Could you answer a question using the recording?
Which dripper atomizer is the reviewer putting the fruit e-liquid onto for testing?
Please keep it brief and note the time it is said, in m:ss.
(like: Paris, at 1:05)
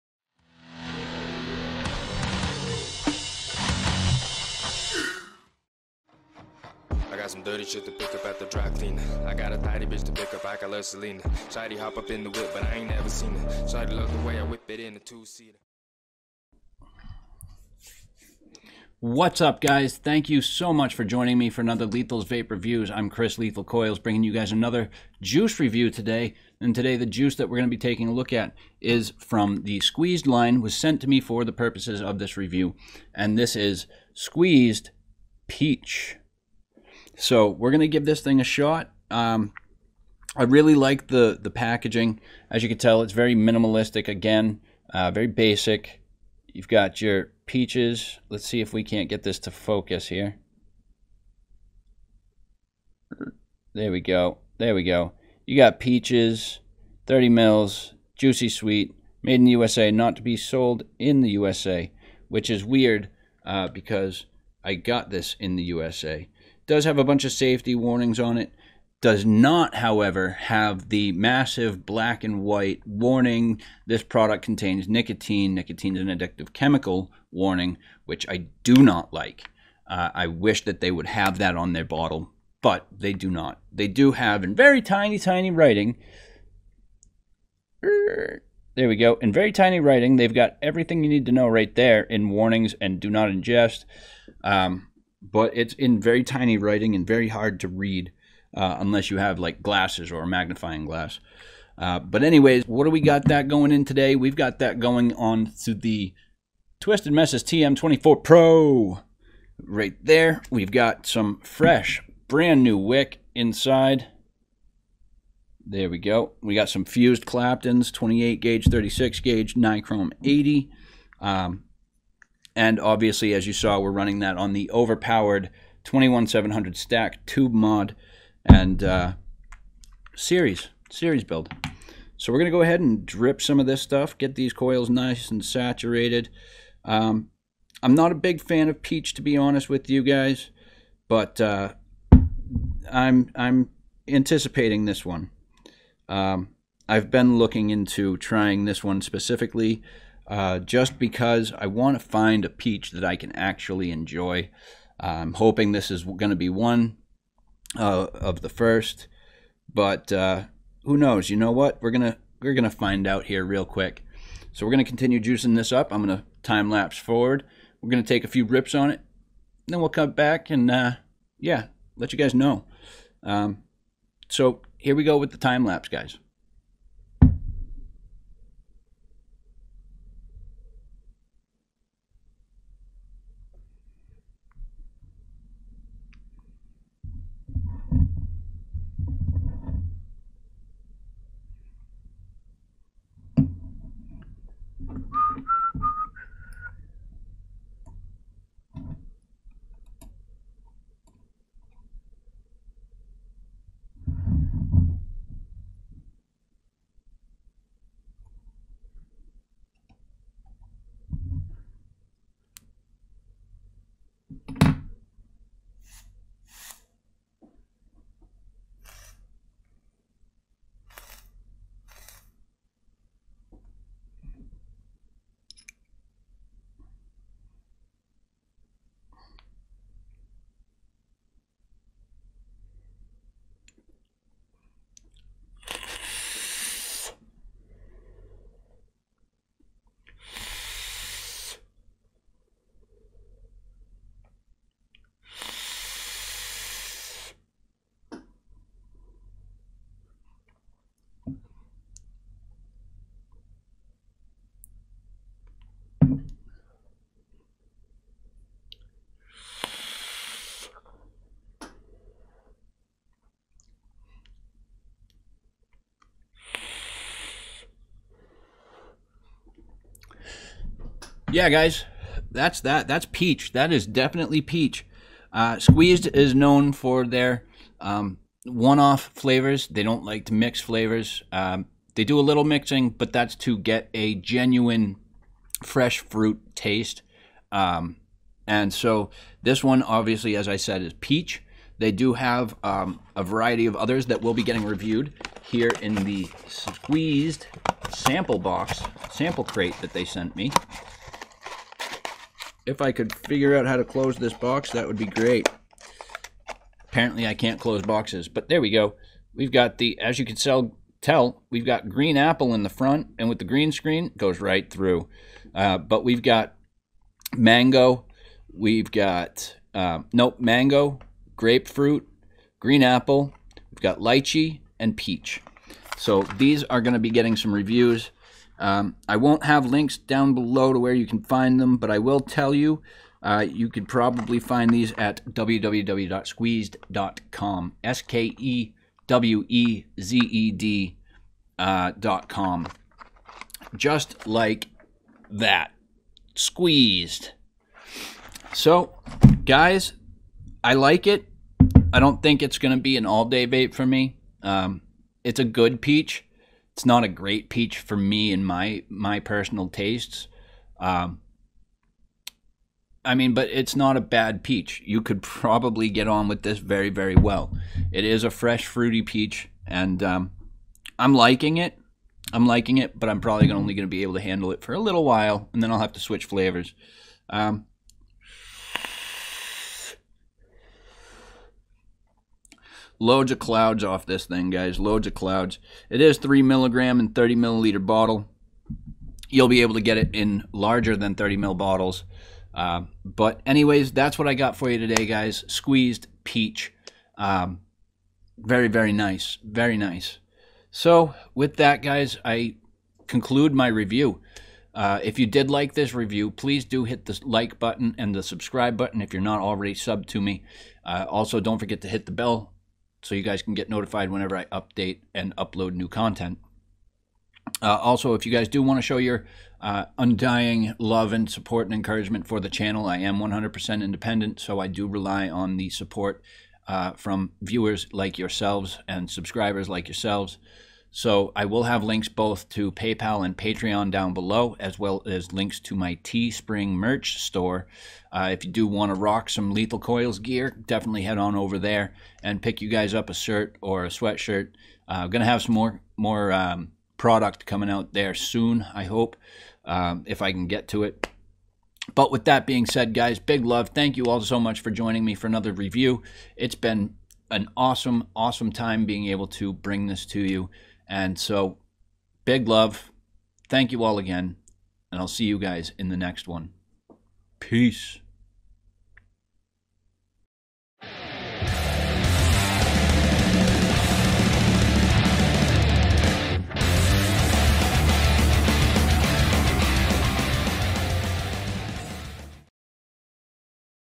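Twisted Messes TM24 Pro, at 1:46.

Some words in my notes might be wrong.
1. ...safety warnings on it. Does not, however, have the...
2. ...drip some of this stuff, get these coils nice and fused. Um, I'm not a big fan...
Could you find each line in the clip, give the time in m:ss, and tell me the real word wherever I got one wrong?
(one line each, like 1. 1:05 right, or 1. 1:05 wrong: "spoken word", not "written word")
1. 1:07 right
2. 2:13 wrong: "saturated", not "fused".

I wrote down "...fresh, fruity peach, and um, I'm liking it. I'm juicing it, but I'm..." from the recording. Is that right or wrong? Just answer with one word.
wrong.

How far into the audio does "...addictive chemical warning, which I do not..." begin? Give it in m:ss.
1:16.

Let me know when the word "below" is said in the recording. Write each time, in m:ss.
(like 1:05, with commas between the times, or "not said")
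5:30, 7:14.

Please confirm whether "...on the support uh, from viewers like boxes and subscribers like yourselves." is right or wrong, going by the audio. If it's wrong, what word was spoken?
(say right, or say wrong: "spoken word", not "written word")
wrong: "yourselves", not "boxes".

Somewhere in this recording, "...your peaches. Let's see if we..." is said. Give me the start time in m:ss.
0:46.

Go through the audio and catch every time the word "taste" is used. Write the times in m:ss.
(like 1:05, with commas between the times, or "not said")
4:46, 5:59.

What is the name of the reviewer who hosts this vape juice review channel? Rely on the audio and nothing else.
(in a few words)
Chris Lethal Coilz.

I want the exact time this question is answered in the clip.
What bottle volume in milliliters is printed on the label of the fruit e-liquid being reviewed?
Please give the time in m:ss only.
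0:57.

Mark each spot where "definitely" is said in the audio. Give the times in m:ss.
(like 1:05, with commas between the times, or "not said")
4:33, 7:20.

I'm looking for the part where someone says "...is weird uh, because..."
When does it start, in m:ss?
1:02.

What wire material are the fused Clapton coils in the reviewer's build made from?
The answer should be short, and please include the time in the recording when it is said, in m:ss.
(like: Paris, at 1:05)
Nichrome 80, at 1:59.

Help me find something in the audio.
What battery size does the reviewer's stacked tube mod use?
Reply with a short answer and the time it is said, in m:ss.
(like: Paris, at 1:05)
21700, at 2:05.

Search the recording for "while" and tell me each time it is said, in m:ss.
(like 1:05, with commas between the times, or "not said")
6:15.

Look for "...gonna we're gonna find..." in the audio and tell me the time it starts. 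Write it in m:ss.
2:41.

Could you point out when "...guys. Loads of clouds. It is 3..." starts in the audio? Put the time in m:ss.
6:24.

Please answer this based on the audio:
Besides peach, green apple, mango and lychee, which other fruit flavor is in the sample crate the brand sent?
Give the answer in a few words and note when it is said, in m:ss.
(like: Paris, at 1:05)
grapefruit, at 5:21.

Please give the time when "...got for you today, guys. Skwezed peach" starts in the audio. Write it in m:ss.
6:34.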